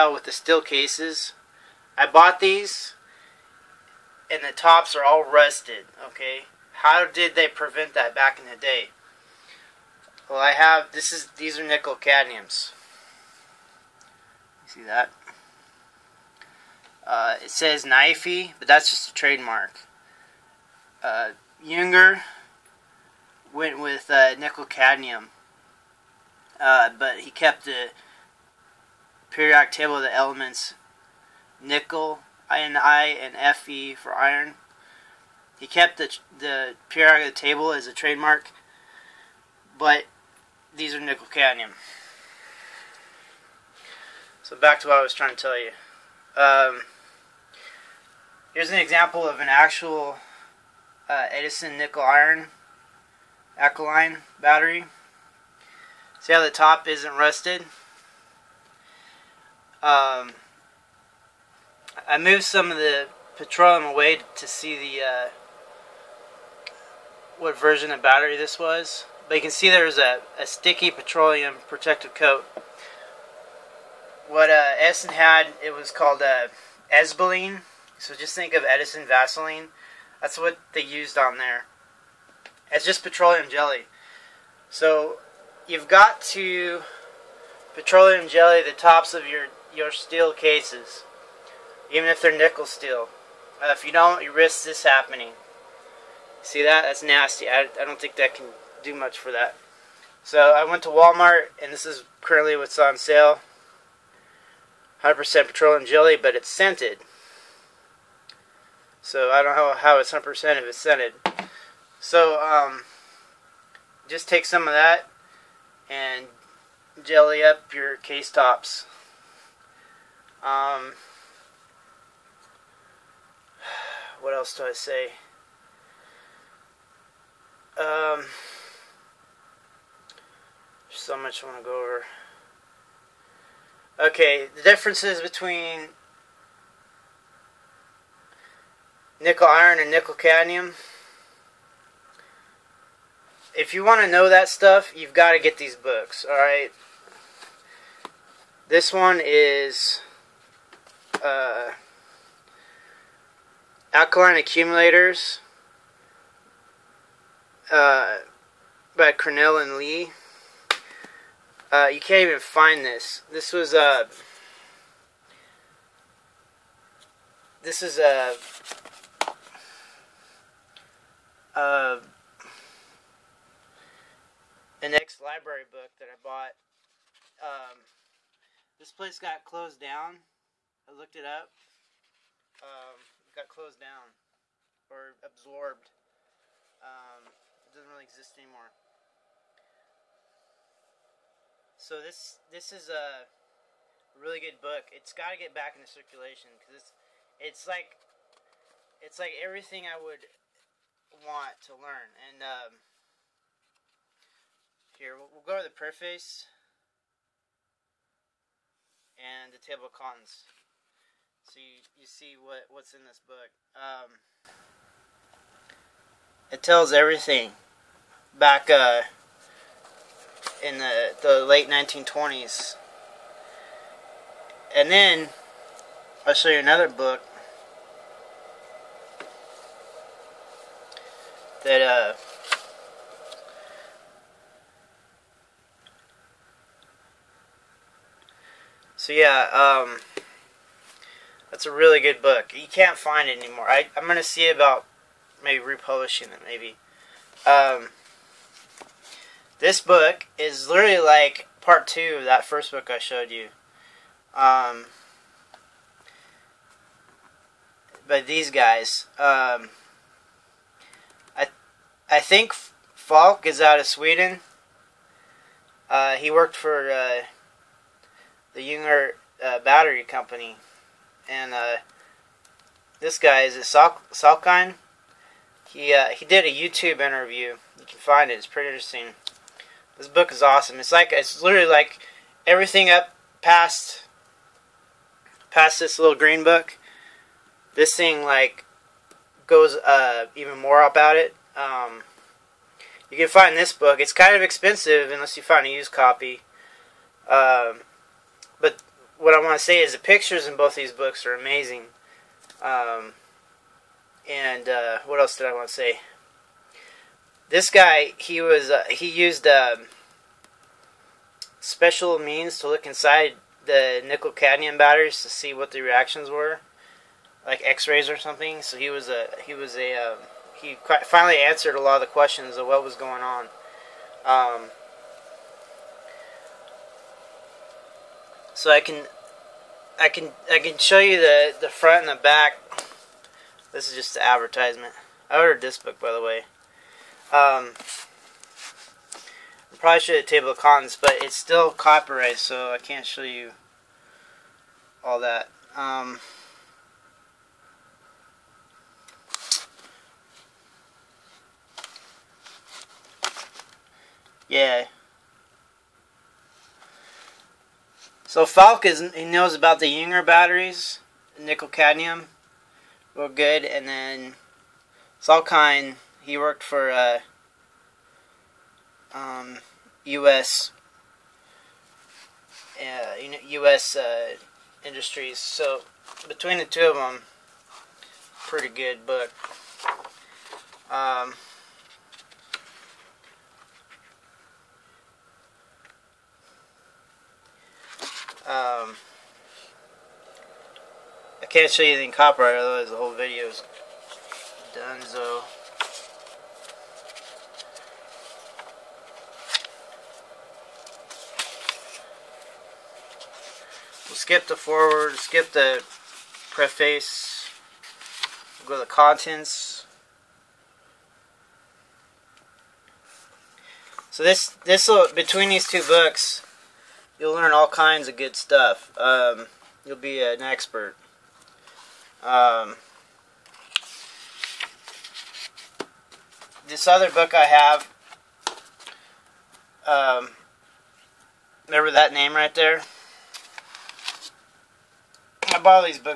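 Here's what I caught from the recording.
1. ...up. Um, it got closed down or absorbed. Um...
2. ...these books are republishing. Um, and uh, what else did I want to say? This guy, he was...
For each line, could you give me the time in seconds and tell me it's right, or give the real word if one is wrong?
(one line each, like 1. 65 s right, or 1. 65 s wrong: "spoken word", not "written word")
1. 181 s right
2. 300 s wrong: "amazing", not "republishing".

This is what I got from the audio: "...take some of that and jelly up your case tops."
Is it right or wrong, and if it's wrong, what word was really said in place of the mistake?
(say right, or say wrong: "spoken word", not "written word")
right.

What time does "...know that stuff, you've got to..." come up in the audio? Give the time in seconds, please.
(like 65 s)
144 s.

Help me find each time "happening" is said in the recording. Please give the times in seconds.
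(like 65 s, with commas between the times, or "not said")
94 s.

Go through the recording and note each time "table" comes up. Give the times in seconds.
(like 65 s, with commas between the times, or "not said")
29 s, 37 s, 209 s, 340 s.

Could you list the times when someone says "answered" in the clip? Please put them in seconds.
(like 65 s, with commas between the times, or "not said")
321 s.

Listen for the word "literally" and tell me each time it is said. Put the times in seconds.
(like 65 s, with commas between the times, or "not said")
250 s, 281 s.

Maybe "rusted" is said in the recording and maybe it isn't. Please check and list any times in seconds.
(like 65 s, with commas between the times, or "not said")
5 s, 57 s.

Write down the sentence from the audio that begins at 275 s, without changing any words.
He uh, he did a YouTube interview.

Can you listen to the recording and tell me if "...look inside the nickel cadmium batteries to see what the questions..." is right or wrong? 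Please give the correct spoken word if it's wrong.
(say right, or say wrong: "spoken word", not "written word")
wrong: "reactions", not "questions".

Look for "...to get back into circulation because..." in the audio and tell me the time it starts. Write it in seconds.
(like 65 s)
195 s.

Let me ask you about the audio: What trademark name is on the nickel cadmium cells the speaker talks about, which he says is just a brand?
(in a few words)
NIFE.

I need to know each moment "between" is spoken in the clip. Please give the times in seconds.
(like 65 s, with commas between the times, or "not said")
135 s, 376 s, 415 s.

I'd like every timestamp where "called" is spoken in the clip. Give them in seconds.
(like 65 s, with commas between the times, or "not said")
75 s.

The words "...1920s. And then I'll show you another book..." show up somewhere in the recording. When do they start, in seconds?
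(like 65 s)
221 s.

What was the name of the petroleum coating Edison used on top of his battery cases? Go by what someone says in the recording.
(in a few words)
Esbeline.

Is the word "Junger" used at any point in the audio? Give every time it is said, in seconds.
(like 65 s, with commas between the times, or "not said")
21 s, 268 s, 359 s.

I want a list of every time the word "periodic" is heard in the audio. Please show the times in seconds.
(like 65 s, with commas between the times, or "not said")
29 s, 36 s.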